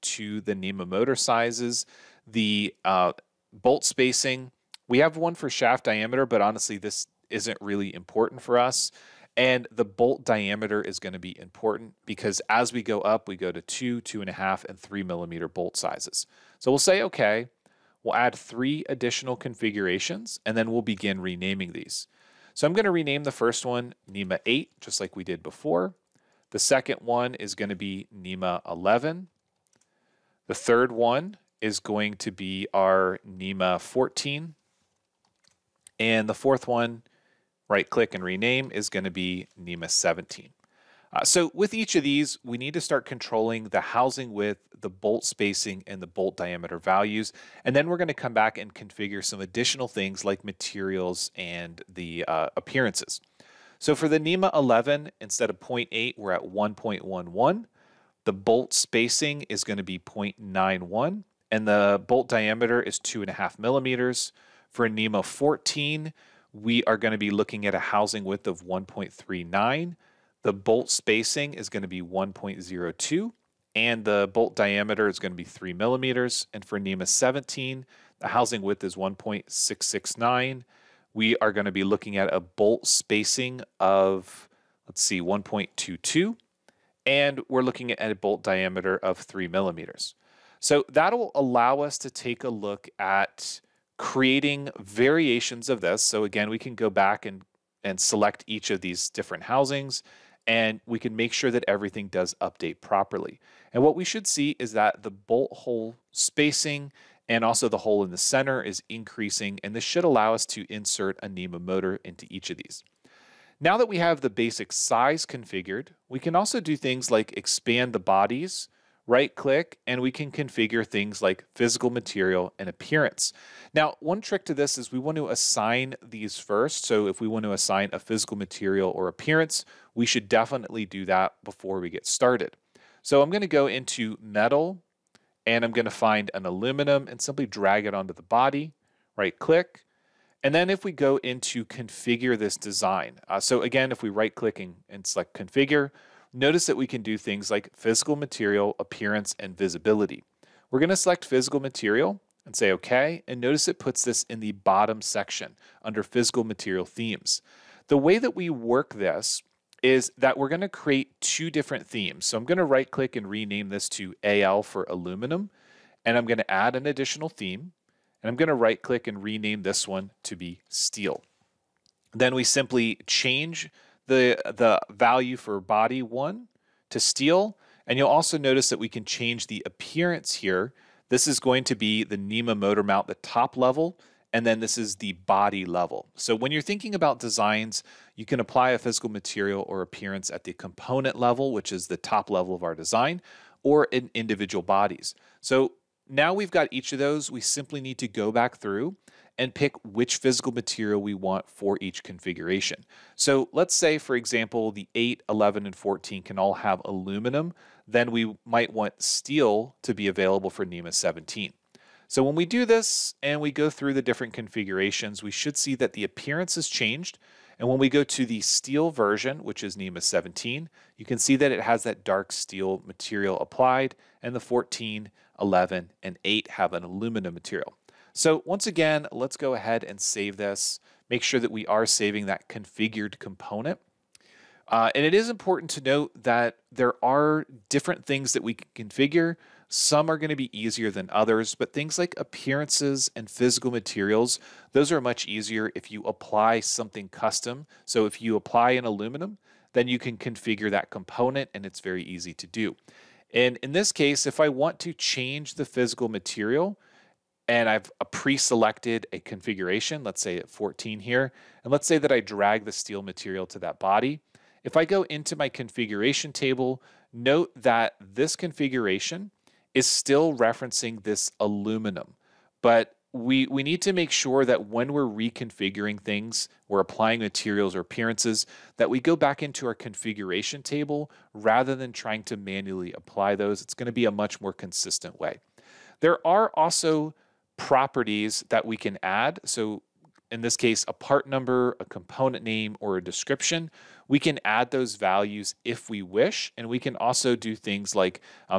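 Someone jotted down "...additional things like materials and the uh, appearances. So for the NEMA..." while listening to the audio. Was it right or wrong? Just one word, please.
right.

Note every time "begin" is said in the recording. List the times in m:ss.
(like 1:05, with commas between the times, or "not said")
0:20.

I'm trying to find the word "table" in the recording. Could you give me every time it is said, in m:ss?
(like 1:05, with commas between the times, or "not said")
4:26, 4:40.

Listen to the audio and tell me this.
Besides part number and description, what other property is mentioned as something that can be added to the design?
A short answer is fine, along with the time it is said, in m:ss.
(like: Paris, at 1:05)
component name, at 4:51.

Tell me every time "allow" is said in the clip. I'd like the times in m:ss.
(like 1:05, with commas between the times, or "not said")
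1:31, 1:50.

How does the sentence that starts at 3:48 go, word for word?
So once again, let's go ahead and save this.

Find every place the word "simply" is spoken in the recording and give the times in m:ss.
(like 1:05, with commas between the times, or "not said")
2:17, 2:52, 3:17.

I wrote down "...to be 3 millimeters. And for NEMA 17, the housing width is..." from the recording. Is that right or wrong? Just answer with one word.
right.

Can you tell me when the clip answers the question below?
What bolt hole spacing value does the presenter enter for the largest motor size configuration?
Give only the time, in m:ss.
1:25.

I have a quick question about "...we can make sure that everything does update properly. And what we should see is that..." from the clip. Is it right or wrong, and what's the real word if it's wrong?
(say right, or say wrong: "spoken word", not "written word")
right.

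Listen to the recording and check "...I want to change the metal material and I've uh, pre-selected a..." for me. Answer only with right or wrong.
wrong.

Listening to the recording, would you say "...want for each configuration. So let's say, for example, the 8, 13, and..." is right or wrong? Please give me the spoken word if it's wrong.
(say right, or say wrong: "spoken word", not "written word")
wrong: "11", not "13".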